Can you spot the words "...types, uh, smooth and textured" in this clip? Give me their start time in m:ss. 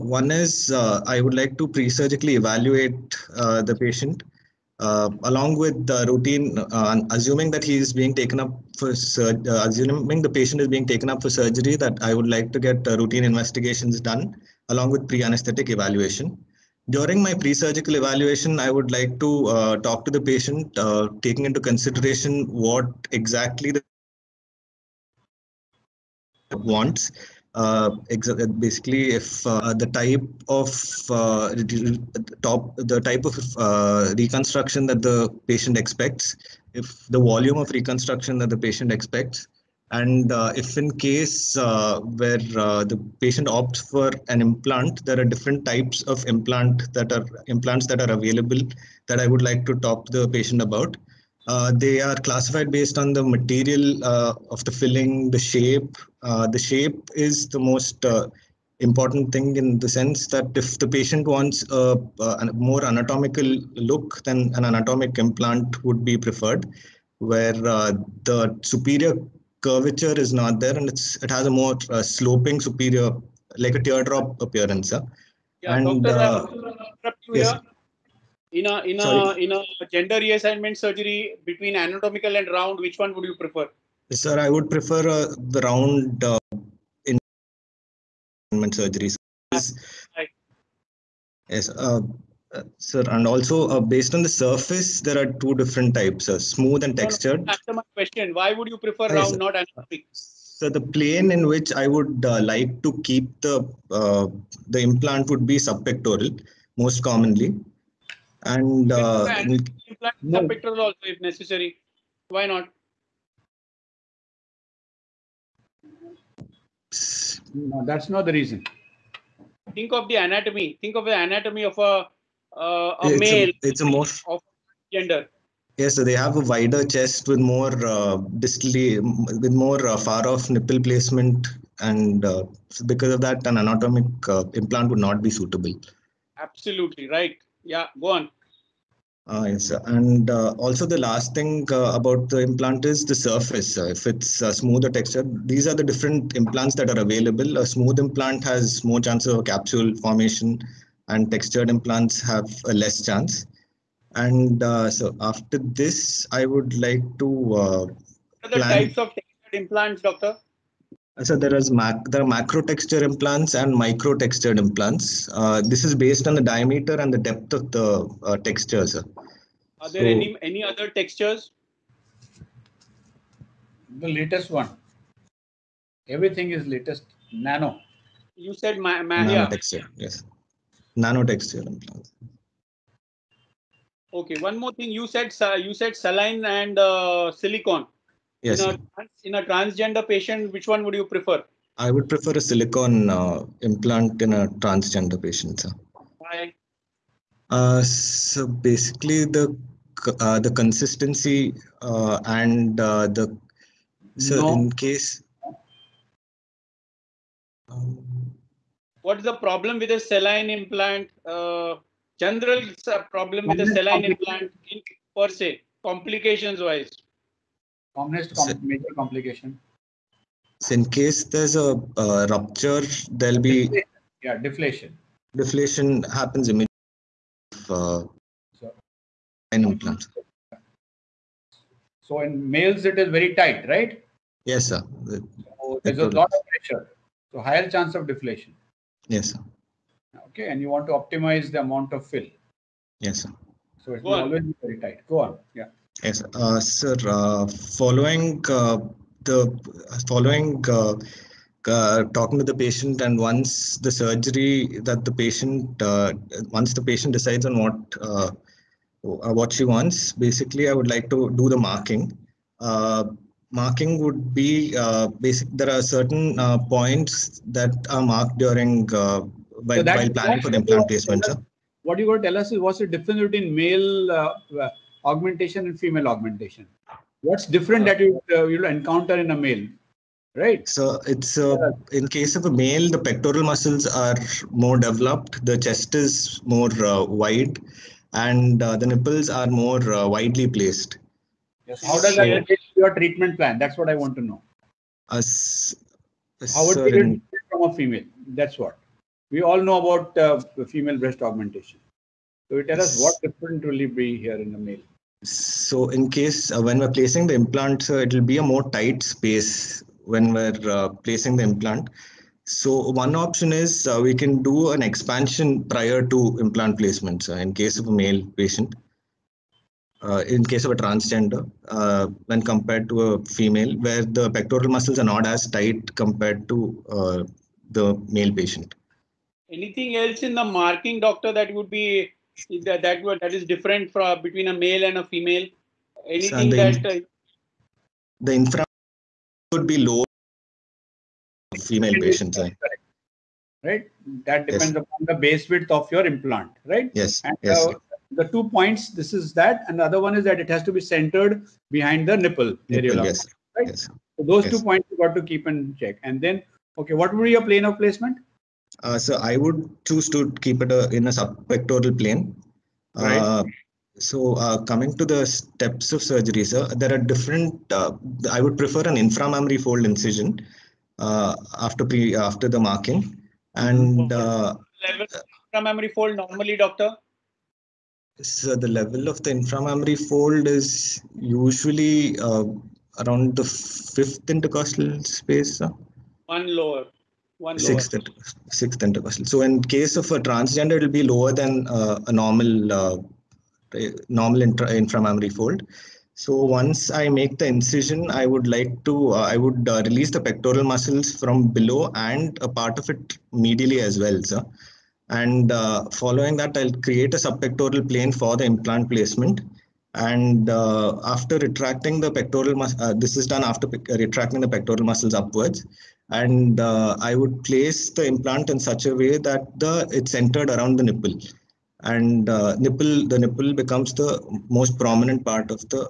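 1:35.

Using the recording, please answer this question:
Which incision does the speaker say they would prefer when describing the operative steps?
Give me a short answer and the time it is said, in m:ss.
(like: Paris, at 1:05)
Inframammary fold incision, at 6:09.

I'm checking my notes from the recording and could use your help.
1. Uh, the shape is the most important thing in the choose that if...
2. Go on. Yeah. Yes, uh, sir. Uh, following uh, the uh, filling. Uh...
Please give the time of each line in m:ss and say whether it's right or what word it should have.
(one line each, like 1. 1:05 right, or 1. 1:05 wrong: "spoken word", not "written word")
1. 0:56 wrong: "sense", not "choose"
2. 4:05 wrong: "following", not "filling".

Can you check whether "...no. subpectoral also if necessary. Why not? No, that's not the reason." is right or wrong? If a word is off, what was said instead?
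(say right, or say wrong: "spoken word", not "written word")
right.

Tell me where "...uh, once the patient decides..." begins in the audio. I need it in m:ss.
4:15.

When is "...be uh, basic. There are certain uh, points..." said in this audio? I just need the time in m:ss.
4:24.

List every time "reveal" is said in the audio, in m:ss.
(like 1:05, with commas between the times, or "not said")
not said.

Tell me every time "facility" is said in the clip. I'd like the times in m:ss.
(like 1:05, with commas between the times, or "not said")
not said.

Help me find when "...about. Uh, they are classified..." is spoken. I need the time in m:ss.
0:50.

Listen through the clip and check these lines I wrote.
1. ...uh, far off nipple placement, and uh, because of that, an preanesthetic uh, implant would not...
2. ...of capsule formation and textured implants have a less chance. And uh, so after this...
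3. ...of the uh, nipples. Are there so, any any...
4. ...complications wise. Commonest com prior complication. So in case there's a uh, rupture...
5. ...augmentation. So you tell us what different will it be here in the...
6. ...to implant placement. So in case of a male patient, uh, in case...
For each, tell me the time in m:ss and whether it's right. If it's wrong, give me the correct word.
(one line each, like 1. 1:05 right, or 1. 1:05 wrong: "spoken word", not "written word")
1. 2:09 wrong: "anatomic", not "preanesthetic"
2. 2:29 right
3. 2:47 wrong: "textures", not "nipples"
4. 3:35 wrong: "major", not "prior"
5. 5:01 right
6. 5:16 right.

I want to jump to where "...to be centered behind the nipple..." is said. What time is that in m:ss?
5:50.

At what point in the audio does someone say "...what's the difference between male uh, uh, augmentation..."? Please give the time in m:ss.
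4:32.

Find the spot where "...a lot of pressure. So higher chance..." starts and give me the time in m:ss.
3:55.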